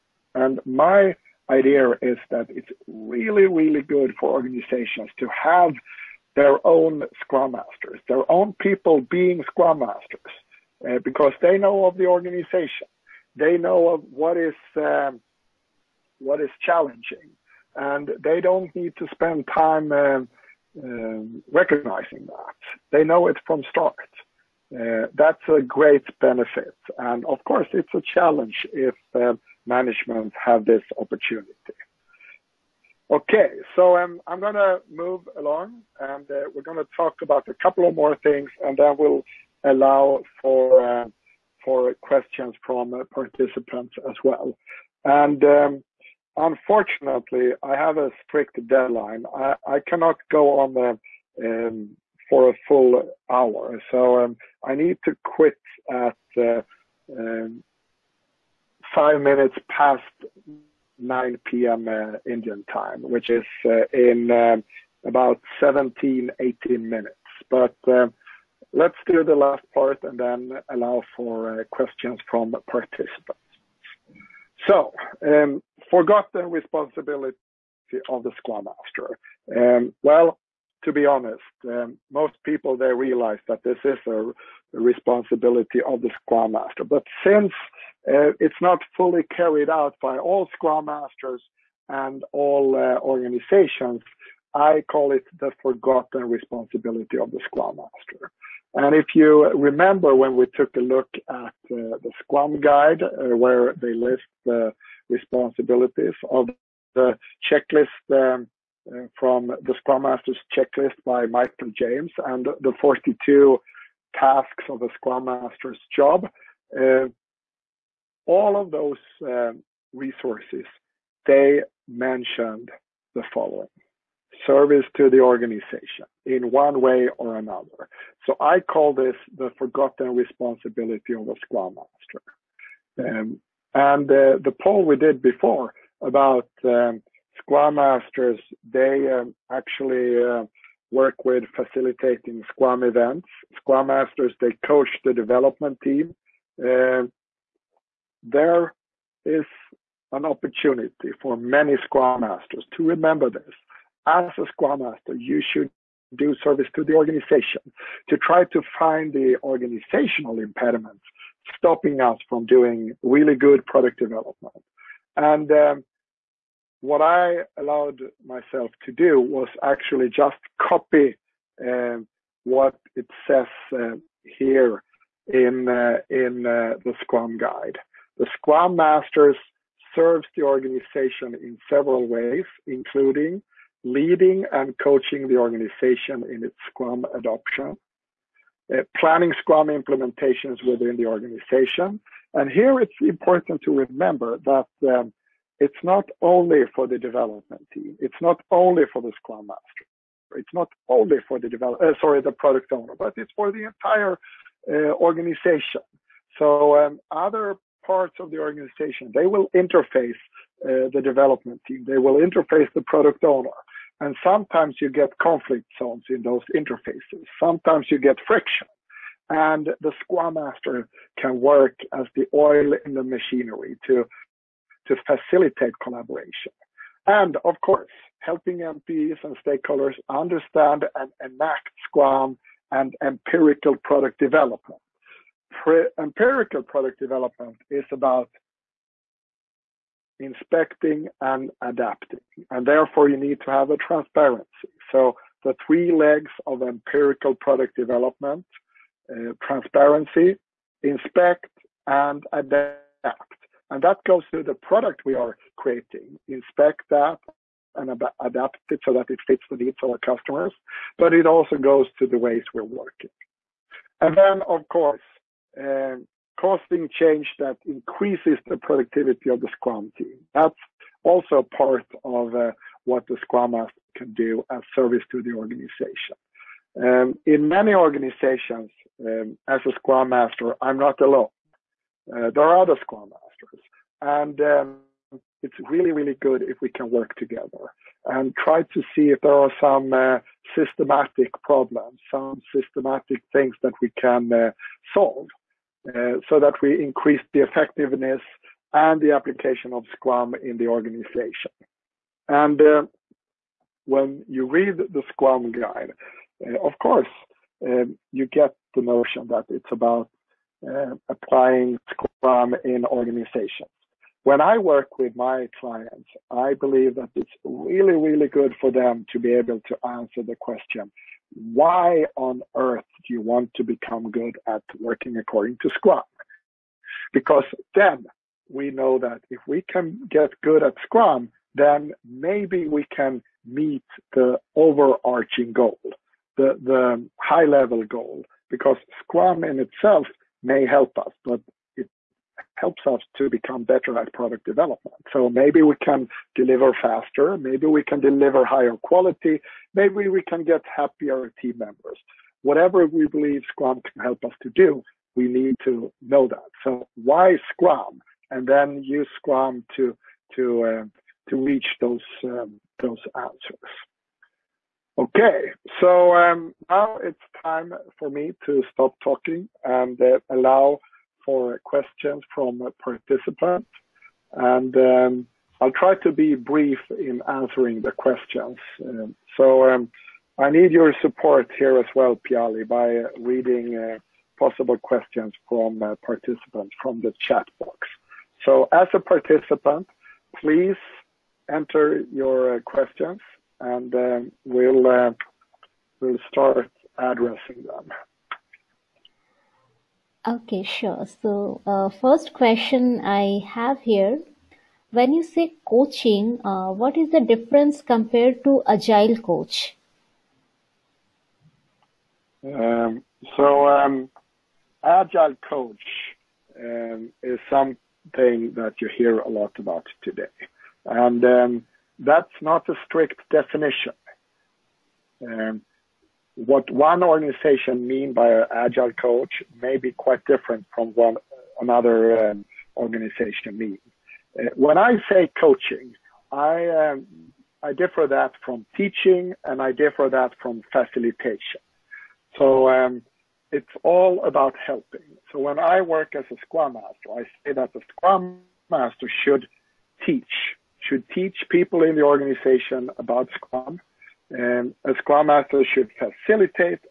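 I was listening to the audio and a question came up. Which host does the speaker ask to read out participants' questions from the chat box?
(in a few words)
Piali.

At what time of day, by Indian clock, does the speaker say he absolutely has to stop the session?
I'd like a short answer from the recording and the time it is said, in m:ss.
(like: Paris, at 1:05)
9 P.M., at 1:01.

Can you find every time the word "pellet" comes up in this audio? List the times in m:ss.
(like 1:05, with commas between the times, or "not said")
not said.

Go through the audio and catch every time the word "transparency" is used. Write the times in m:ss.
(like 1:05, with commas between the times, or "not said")
4:03, 4:09.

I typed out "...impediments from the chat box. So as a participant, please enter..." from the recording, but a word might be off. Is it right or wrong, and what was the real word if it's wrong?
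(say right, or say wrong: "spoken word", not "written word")
wrong: "participants", not "impediments".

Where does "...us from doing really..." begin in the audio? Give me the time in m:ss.
2:42.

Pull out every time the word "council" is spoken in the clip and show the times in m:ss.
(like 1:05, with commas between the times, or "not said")
not said.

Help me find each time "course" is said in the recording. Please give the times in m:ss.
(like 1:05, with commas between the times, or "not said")
0:27, 3:47, 4:24, 5:06.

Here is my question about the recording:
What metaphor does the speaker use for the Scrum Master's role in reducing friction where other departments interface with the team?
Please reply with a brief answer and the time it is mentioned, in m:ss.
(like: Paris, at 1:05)
the oil, at 3:42.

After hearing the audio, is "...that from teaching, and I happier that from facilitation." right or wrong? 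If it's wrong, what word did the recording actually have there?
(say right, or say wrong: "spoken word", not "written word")
wrong: "differ", not "happier".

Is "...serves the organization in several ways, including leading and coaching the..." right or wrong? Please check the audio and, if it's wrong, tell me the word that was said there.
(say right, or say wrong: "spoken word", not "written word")
right.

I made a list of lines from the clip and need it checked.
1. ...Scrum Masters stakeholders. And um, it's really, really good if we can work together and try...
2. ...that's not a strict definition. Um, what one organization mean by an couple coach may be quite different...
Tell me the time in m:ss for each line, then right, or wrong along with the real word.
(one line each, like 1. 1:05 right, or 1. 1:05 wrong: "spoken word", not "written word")
1. 4:42 wrong: "investors", not "stakeholders"
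2. 7:01 wrong: "agile", not "couple".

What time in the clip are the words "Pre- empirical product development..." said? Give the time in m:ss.
3:55.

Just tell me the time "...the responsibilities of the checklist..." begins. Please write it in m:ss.
1:44.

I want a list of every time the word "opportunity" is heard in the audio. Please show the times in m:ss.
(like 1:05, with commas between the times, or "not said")
0:30, 2:30.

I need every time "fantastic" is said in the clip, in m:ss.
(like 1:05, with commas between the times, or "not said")
not said.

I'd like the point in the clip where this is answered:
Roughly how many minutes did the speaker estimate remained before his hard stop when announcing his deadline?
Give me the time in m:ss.
1:05.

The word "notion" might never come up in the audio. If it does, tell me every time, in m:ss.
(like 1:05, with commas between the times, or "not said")
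5:08.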